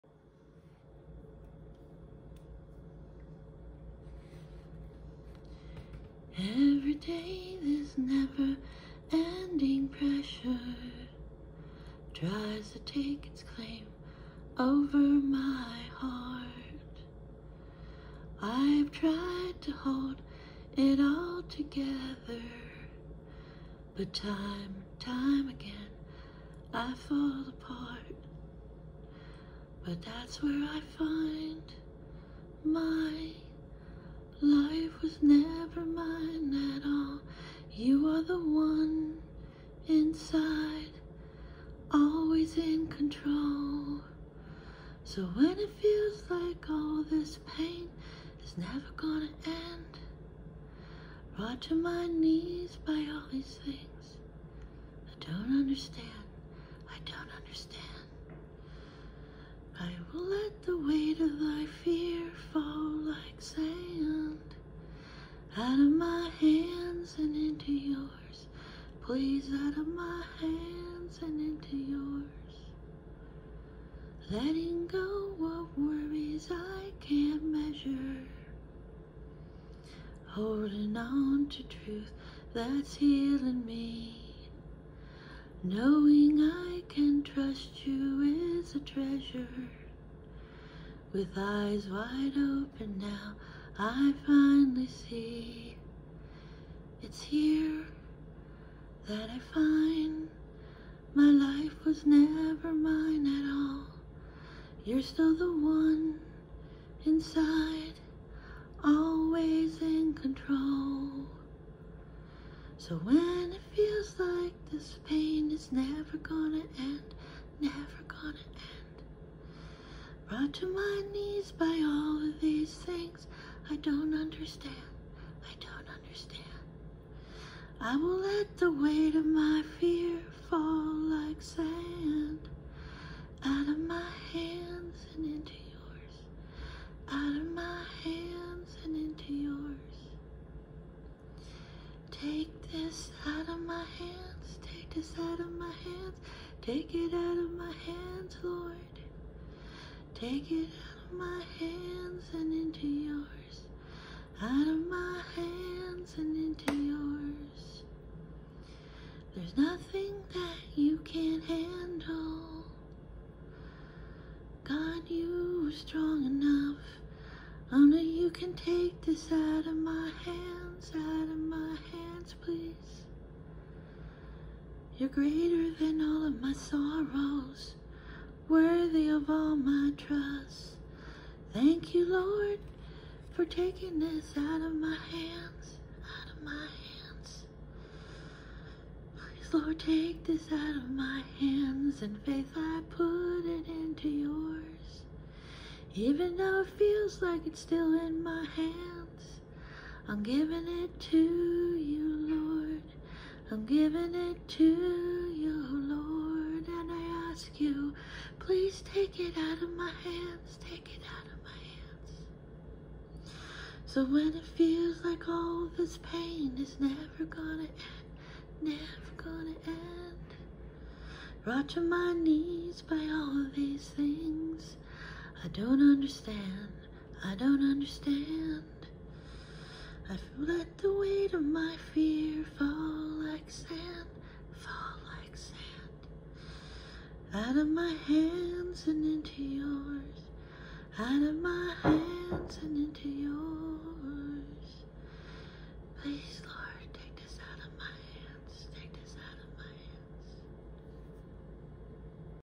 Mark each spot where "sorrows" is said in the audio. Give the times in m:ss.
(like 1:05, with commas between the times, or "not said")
2:56.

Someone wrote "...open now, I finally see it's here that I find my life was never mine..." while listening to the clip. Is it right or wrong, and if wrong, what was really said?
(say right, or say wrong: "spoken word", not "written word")
right.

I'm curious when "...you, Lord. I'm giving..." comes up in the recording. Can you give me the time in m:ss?
3:21.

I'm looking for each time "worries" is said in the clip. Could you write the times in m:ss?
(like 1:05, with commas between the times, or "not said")
1:15.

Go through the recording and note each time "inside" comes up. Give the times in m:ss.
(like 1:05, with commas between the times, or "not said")
0:39, 1:47.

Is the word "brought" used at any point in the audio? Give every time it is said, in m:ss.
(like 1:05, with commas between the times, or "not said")
0:51, 2:00, 3:41.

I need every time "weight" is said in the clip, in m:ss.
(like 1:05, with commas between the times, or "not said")
1:00, 2:08, 3:50.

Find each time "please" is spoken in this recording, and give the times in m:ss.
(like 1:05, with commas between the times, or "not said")
2:52, 3:28.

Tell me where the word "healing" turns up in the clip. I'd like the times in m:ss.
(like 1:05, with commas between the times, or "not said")
1:22.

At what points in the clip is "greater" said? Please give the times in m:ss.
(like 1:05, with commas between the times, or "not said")
2:55.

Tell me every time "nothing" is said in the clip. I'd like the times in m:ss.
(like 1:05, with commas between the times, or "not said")
2:39.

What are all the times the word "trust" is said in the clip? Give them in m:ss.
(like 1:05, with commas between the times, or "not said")
1:27, 2:59.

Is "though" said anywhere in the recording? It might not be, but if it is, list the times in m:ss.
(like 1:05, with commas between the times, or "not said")
3:16.